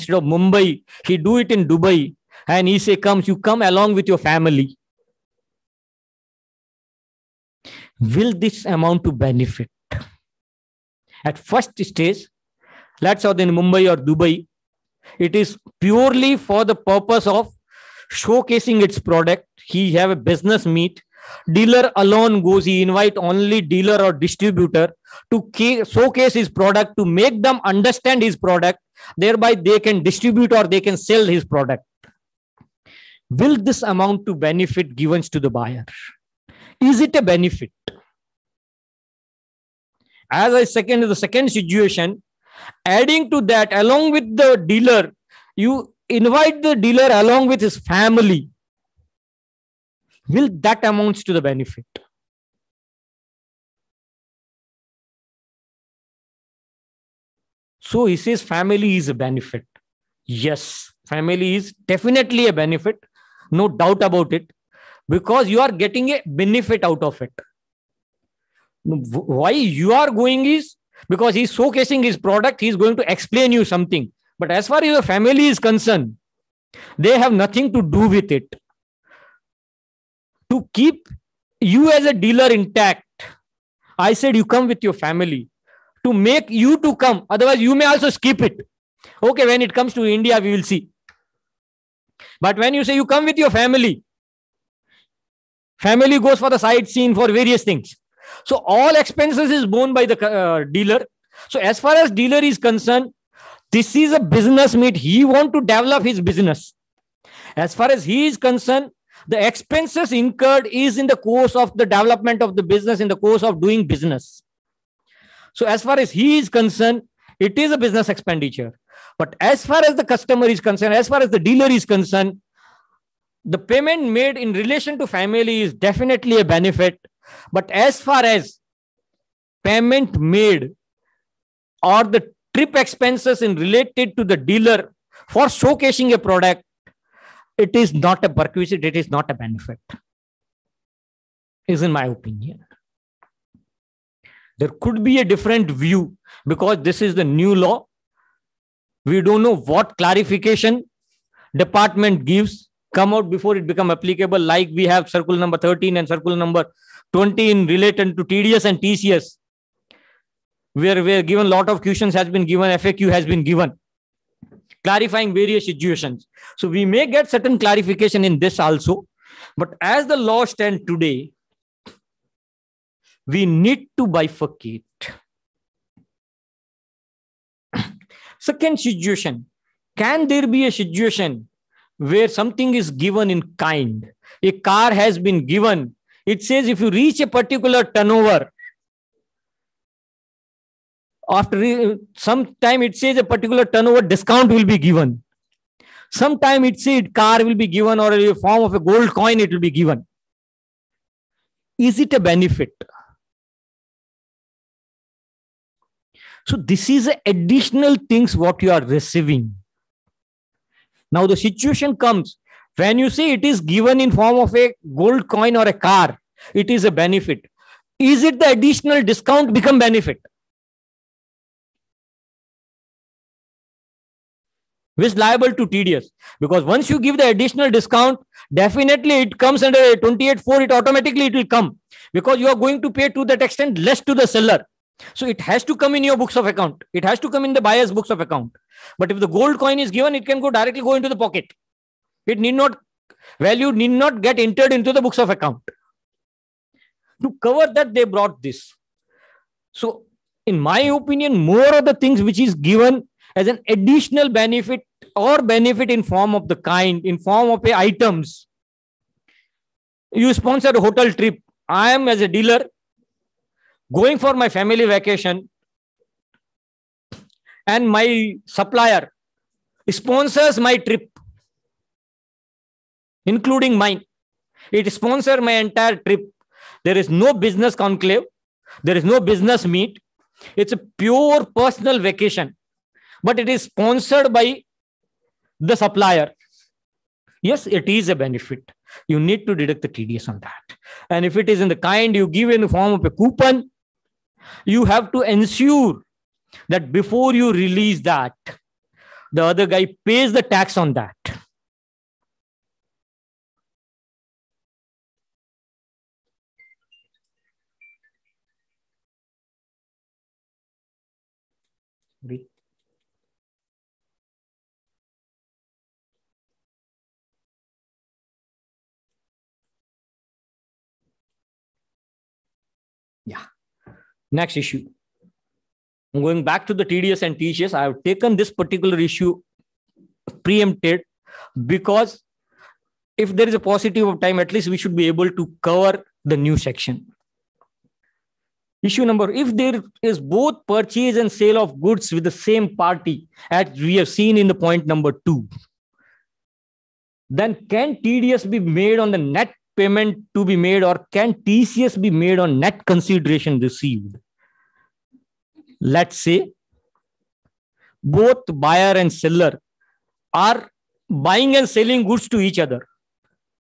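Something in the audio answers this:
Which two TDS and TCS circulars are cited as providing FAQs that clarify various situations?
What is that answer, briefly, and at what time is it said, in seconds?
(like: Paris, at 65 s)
13 and 20, at 155 s.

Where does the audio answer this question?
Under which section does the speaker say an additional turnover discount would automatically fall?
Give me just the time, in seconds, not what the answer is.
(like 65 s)
229 s.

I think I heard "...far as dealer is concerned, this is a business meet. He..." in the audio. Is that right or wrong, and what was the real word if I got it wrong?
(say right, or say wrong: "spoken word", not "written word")
right.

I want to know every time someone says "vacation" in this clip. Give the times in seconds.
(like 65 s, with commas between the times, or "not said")
264 s, 281 s.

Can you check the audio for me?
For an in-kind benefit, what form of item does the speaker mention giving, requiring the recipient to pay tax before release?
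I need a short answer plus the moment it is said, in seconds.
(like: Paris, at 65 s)
Coupon, at 293 s.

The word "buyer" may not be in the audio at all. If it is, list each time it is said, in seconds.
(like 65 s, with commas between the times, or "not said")
35 s, 237 s, 358 s.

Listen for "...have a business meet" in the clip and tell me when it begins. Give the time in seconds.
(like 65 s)
19 s.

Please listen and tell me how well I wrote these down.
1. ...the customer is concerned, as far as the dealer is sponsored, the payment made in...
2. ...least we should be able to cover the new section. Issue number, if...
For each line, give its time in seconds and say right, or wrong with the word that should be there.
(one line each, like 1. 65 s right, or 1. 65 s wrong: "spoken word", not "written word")
1. 119 s wrong: "concerned", not "sponsored"
2. 334 s right.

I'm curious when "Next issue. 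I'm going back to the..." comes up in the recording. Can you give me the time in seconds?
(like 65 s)
324 s.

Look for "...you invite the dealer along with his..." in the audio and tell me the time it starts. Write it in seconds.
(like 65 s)
45 s.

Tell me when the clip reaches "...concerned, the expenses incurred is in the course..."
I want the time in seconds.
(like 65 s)
108 s.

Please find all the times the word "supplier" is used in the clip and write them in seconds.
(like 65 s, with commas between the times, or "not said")
268 s, 285 s.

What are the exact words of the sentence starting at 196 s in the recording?
Sometime it says car will be given or a form of a gold coin it will be given.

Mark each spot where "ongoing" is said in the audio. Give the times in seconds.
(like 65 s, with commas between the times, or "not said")
not said.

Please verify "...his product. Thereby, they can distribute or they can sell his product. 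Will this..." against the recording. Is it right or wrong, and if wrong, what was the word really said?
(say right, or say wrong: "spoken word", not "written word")
right.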